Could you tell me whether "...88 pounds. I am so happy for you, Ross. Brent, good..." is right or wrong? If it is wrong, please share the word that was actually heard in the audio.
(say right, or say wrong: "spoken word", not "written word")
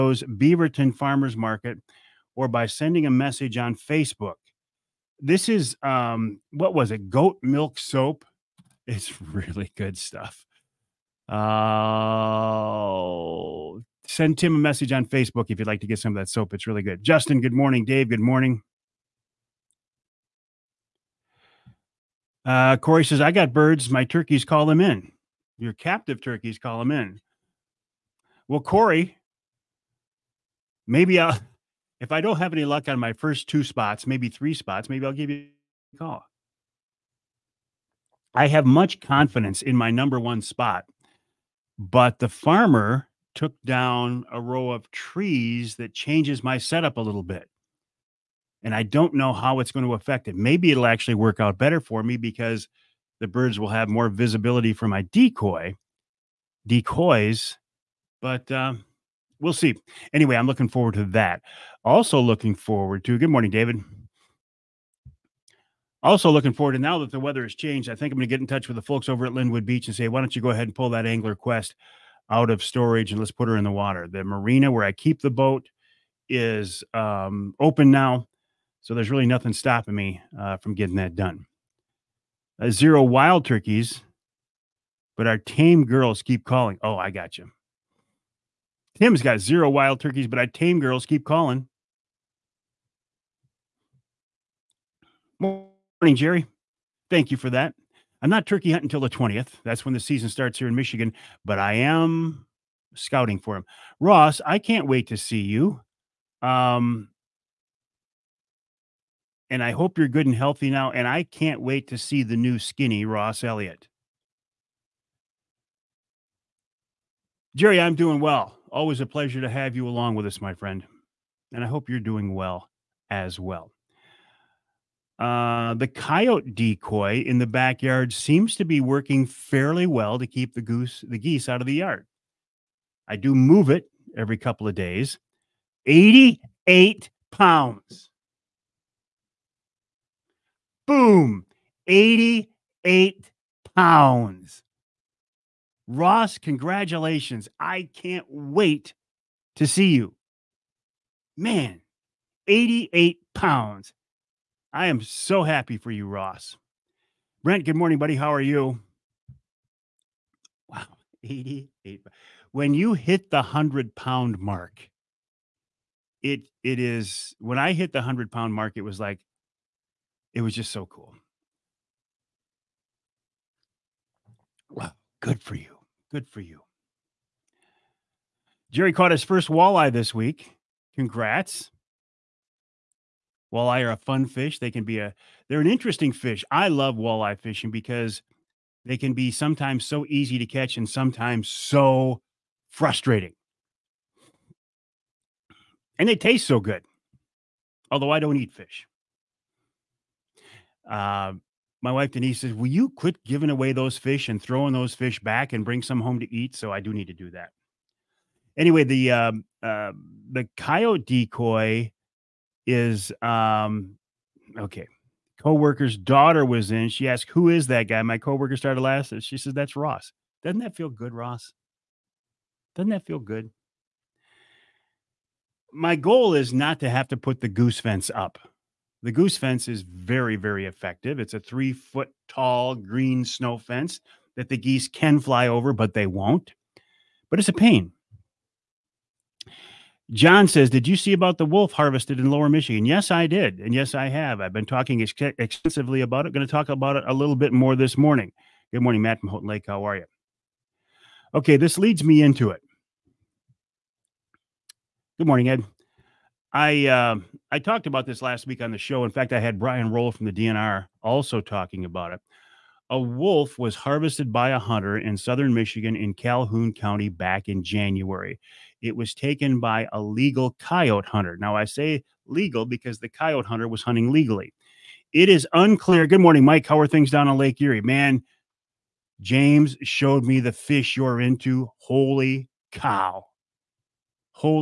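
right.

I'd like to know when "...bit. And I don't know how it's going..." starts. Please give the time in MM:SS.
00:47.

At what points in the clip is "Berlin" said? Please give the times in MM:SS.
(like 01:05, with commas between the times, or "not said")
not said.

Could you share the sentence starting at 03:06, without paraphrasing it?
I love walleye fishing because they can be sometimes so easy to catch and sometimes so frustrating.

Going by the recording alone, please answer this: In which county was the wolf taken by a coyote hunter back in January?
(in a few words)
Calhoun County.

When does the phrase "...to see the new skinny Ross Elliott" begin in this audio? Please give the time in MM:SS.
01:51.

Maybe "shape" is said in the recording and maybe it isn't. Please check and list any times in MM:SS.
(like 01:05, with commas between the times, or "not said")
not said.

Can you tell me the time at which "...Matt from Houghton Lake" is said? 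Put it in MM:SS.
04:09.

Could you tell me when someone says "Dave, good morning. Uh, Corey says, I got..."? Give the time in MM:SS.
00:17.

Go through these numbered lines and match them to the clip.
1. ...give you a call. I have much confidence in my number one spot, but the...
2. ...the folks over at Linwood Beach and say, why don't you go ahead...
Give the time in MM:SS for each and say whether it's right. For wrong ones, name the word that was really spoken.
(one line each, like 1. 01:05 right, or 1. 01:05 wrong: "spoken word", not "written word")
1. 00:35 right
2. 01:08 right.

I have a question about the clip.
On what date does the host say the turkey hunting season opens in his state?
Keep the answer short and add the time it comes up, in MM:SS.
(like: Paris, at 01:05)
The 20th, at 01:39.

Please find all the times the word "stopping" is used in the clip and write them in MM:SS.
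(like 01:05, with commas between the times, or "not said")
01:19.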